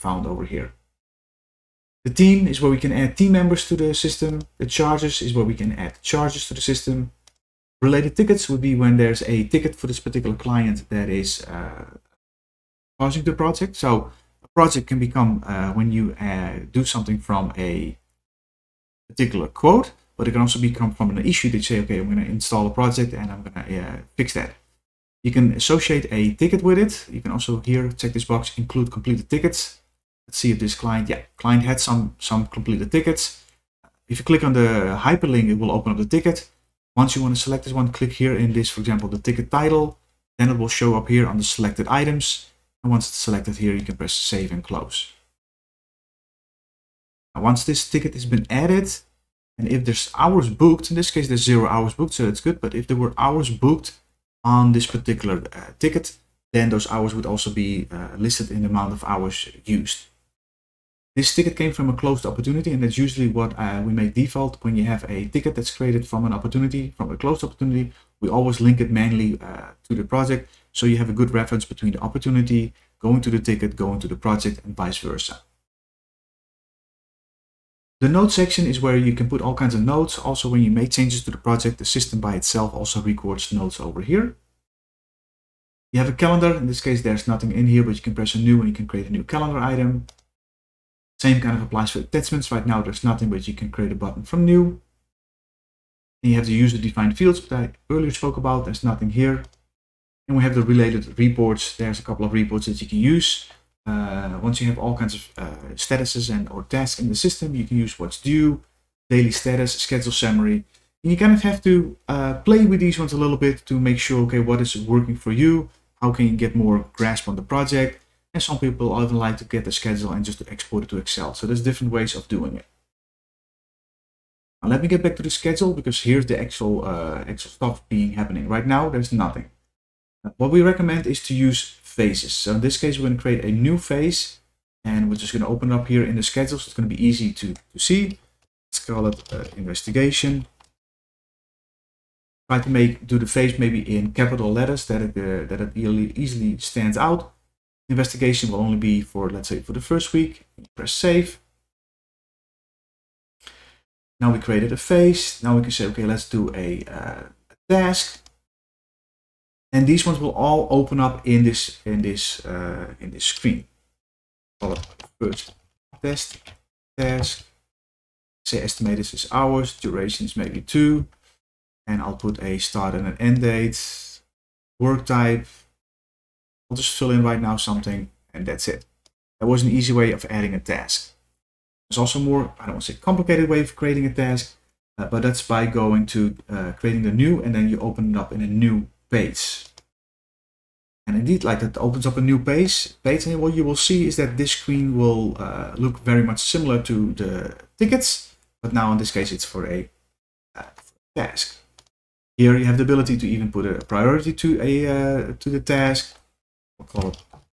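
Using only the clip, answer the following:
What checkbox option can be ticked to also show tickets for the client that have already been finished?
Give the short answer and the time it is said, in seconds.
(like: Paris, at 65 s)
Include completed tickets, at 28 s.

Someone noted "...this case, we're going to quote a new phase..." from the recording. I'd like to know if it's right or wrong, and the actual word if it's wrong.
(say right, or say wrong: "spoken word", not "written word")
wrong: "create", not "quote".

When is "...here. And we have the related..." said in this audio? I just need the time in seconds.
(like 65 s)
99 s.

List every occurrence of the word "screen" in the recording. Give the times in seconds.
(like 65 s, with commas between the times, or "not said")
163 s, 194 s.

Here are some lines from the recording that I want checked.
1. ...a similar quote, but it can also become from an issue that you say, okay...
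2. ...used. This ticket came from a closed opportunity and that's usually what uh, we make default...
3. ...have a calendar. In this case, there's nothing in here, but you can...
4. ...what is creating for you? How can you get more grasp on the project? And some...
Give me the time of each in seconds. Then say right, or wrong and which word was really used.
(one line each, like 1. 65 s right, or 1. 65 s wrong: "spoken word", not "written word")
1. 17 s wrong: "particular", not "similar"
2. 59 s right
3. 86 s right
4. 114 s wrong: "working", not "creating".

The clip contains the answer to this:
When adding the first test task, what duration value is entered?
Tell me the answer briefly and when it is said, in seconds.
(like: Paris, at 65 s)
2, at 170 s.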